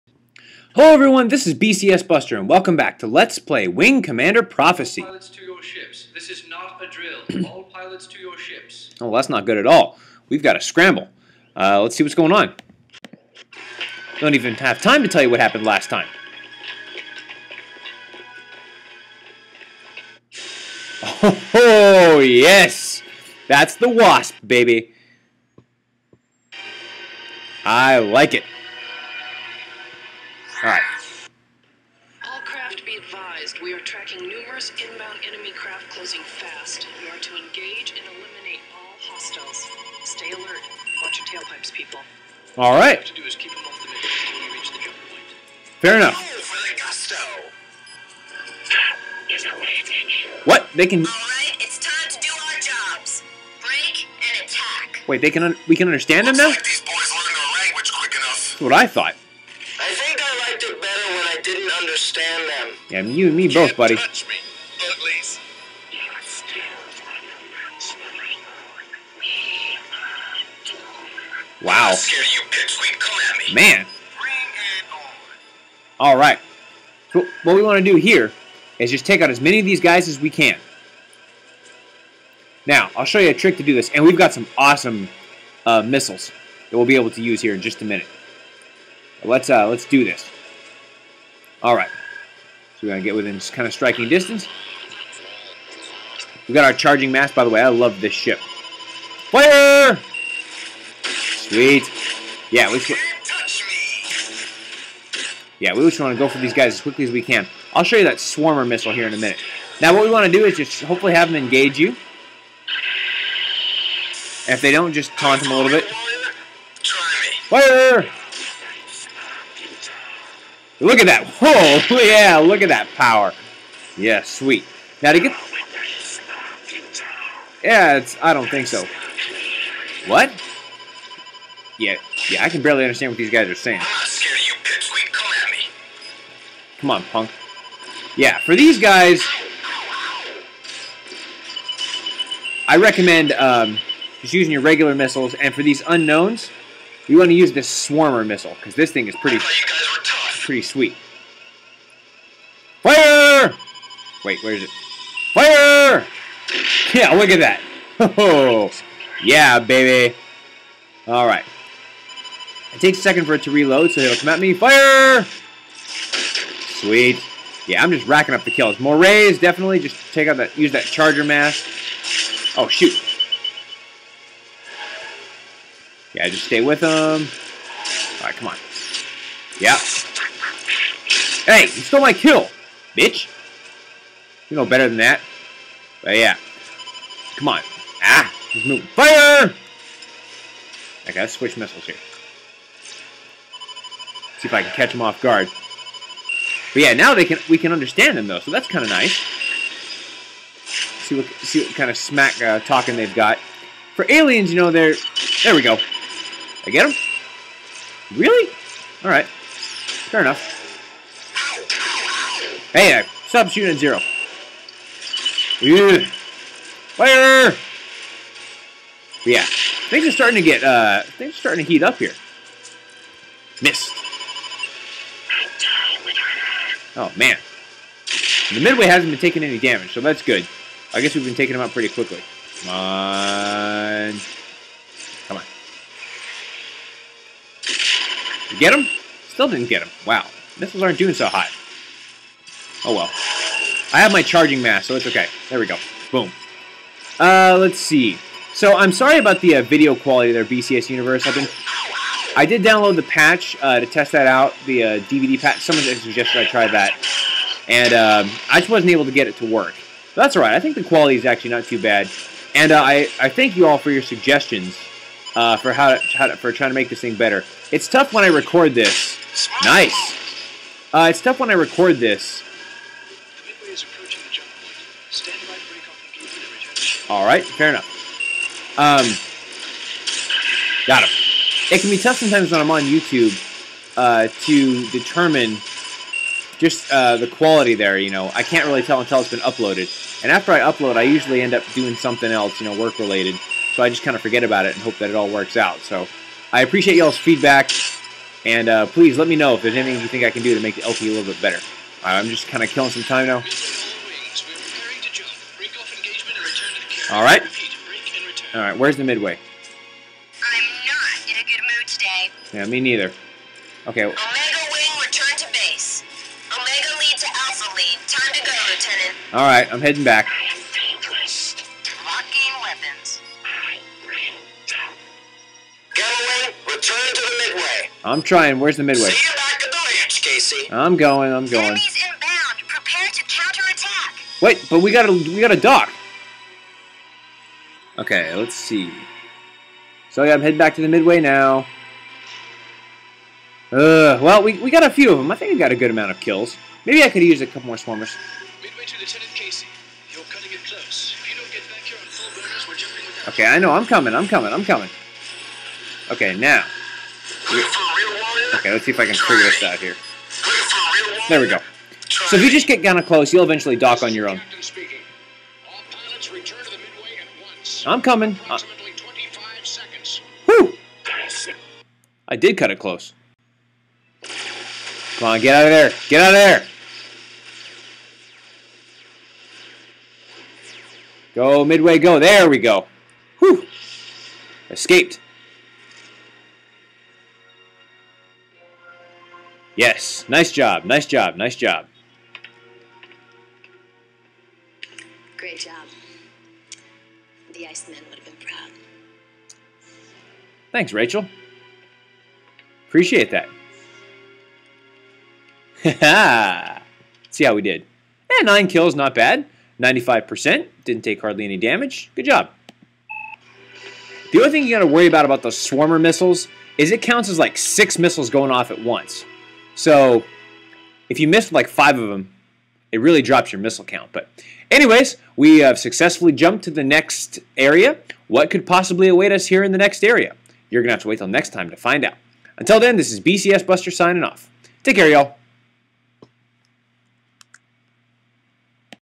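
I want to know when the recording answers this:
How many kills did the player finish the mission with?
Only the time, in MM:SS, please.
06:48.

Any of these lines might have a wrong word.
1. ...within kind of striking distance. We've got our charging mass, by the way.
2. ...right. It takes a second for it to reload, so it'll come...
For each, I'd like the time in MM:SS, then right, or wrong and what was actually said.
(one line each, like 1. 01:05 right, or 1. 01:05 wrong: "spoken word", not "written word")
1. 01:33 right
2. 02:41 right.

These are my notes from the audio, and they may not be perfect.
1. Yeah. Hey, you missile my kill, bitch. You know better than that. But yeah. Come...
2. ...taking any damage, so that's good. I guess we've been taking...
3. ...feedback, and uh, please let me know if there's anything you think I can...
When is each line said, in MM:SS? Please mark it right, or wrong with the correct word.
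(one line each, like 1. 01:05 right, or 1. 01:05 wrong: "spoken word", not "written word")
1. 02:59 wrong: "stole", not "missile"
2. 03:49 right
3. 04:57 right.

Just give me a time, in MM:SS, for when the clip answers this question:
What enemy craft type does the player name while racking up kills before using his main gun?
02:48.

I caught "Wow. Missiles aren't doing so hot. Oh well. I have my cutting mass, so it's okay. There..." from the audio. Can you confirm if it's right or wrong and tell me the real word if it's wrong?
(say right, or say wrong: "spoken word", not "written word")
wrong: "charging", not "cutting".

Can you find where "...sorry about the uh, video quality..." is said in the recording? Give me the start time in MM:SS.
04:08.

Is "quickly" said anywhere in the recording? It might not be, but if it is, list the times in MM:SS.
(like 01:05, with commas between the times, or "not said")
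01:46, 03:51.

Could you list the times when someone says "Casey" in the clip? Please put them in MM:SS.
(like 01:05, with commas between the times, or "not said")
05:30, 05:49.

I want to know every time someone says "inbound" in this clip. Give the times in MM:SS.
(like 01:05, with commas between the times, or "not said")
00:34, 05:32.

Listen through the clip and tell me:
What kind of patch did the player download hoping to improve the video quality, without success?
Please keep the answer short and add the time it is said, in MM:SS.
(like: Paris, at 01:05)
DVD patch, at 04:15.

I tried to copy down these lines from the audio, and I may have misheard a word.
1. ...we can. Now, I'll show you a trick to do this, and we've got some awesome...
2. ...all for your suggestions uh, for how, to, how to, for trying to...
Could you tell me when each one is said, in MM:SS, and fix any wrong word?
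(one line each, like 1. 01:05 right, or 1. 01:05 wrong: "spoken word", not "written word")
1. 01:20 right
2. 04:23 right.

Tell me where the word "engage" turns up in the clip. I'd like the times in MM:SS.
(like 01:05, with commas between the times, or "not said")
00:37, 01:51.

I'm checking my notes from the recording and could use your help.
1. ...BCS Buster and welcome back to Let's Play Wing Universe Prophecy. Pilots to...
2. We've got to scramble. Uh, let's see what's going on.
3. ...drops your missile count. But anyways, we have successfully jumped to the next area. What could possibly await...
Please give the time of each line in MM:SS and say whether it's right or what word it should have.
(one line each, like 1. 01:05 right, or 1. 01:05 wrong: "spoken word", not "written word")
1. 00:01 wrong: "Commander", not "Universe"
2. 00:10 right
3. 07:03 right.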